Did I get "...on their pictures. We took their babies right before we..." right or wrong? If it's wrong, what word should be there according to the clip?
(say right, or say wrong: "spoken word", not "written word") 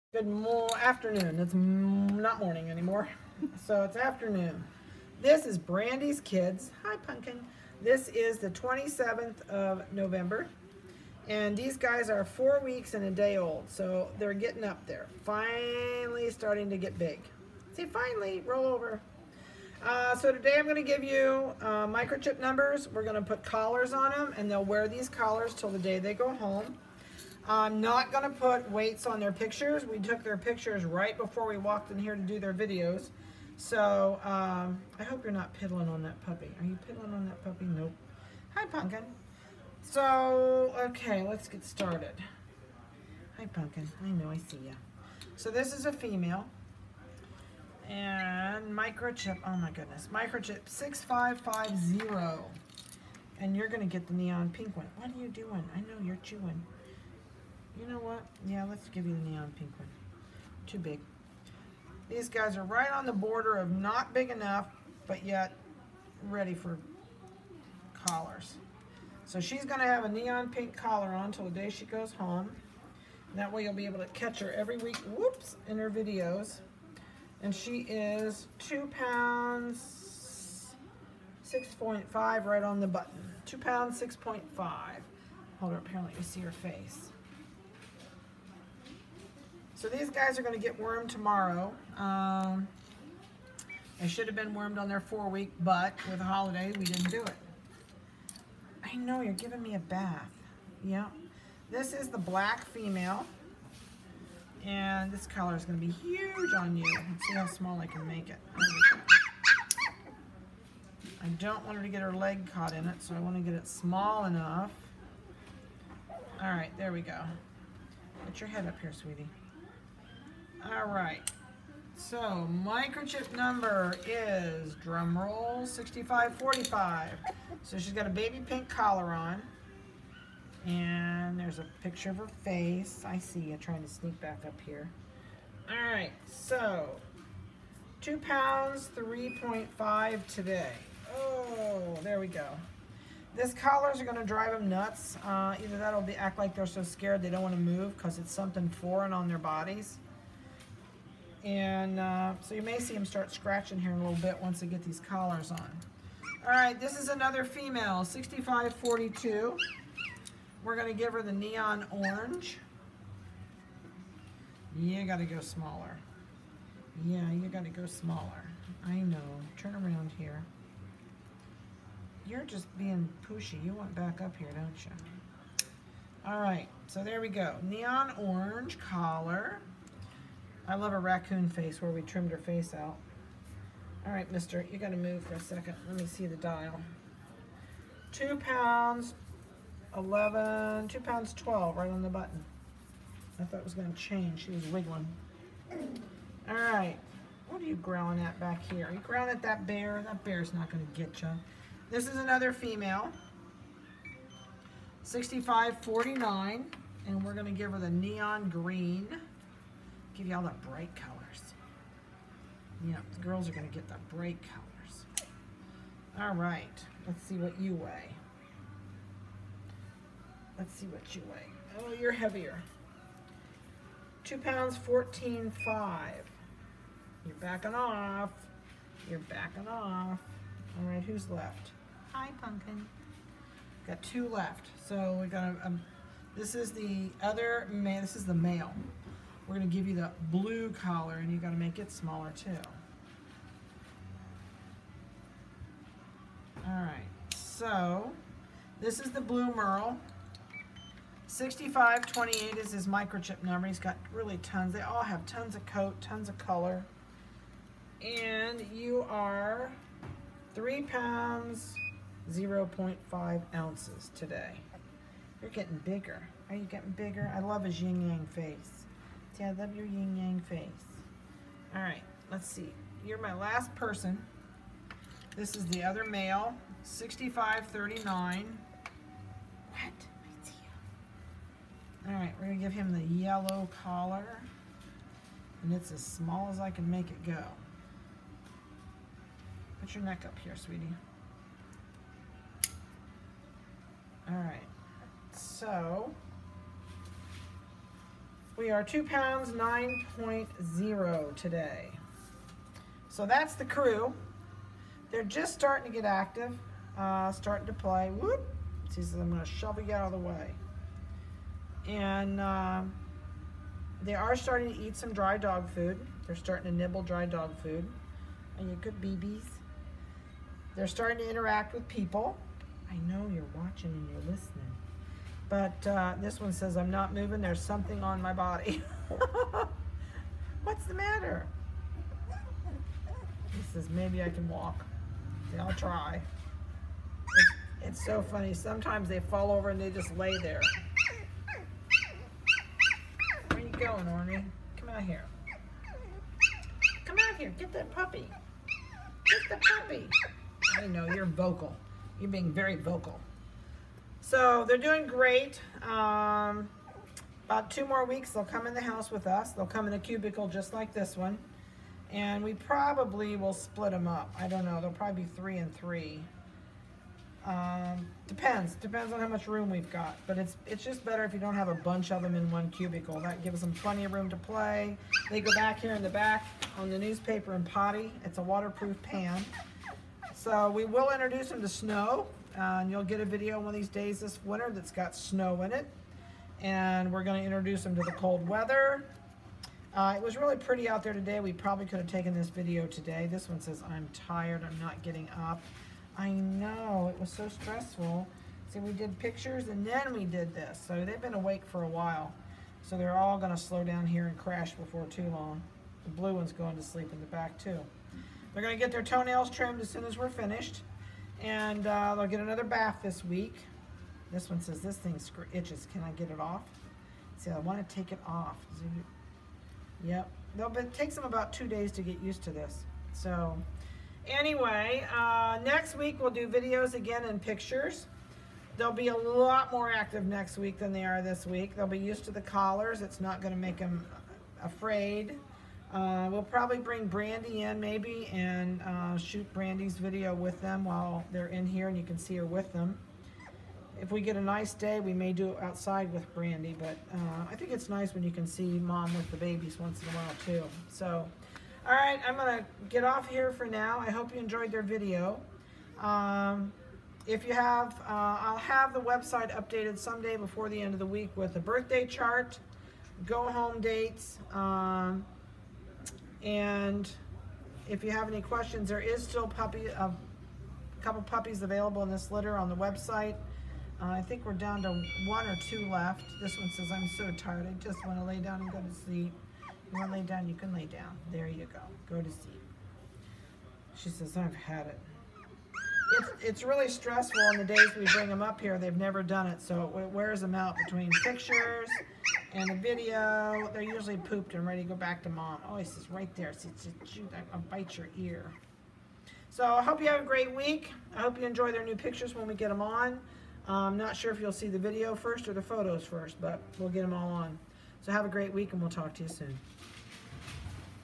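wrong: "pictures", not "babies".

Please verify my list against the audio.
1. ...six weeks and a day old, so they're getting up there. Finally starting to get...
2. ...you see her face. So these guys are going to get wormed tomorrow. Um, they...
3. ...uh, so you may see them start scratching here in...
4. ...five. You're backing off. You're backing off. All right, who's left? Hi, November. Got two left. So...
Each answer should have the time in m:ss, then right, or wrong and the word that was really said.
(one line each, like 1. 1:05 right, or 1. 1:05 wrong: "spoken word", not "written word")
1. 0:12 wrong: "four", not "six"
2. 1:25 right
3. 2:31 right
4. 3:45 wrong: "Pumpkin", not "November".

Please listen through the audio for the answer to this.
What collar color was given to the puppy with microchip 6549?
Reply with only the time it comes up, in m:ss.
3:27.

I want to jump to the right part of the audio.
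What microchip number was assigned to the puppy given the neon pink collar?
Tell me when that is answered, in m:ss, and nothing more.
0:50.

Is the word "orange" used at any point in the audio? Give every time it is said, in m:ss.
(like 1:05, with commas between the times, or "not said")
2:41, 2:58.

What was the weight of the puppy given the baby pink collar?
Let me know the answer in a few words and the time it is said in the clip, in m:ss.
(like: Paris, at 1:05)
2 pounds 3.5, at 2:18.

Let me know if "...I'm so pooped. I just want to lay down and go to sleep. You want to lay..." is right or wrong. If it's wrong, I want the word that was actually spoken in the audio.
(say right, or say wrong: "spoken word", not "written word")
wrong: "tired", not "pooped".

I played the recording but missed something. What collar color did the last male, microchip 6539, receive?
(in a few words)
Yellow.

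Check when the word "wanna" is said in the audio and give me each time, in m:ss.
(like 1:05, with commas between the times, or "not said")
2:27.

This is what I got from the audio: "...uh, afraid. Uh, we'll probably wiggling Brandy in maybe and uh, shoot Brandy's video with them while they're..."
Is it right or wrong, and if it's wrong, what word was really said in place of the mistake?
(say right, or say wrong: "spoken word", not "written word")
wrong: "bring", not "wiggling".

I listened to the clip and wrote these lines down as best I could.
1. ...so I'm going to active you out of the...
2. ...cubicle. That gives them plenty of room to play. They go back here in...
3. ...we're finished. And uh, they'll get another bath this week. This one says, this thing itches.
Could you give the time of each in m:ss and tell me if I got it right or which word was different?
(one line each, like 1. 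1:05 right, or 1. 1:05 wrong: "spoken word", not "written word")
1. 5:09 wrong: "shove", not "active"
2. 6:12 right
3. 6:50 right.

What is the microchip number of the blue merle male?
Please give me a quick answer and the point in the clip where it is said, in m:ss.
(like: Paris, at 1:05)
6528, at 4:11.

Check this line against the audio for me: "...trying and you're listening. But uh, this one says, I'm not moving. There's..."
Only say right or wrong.
wrong.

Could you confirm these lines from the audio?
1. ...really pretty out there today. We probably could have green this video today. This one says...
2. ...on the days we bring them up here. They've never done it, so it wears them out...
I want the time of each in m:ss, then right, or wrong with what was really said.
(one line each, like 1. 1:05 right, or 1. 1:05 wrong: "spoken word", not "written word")
1. 6:30 wrong: "taken", not "green"
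2. 8:07 right.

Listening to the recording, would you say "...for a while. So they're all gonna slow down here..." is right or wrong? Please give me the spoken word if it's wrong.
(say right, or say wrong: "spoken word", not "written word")
right.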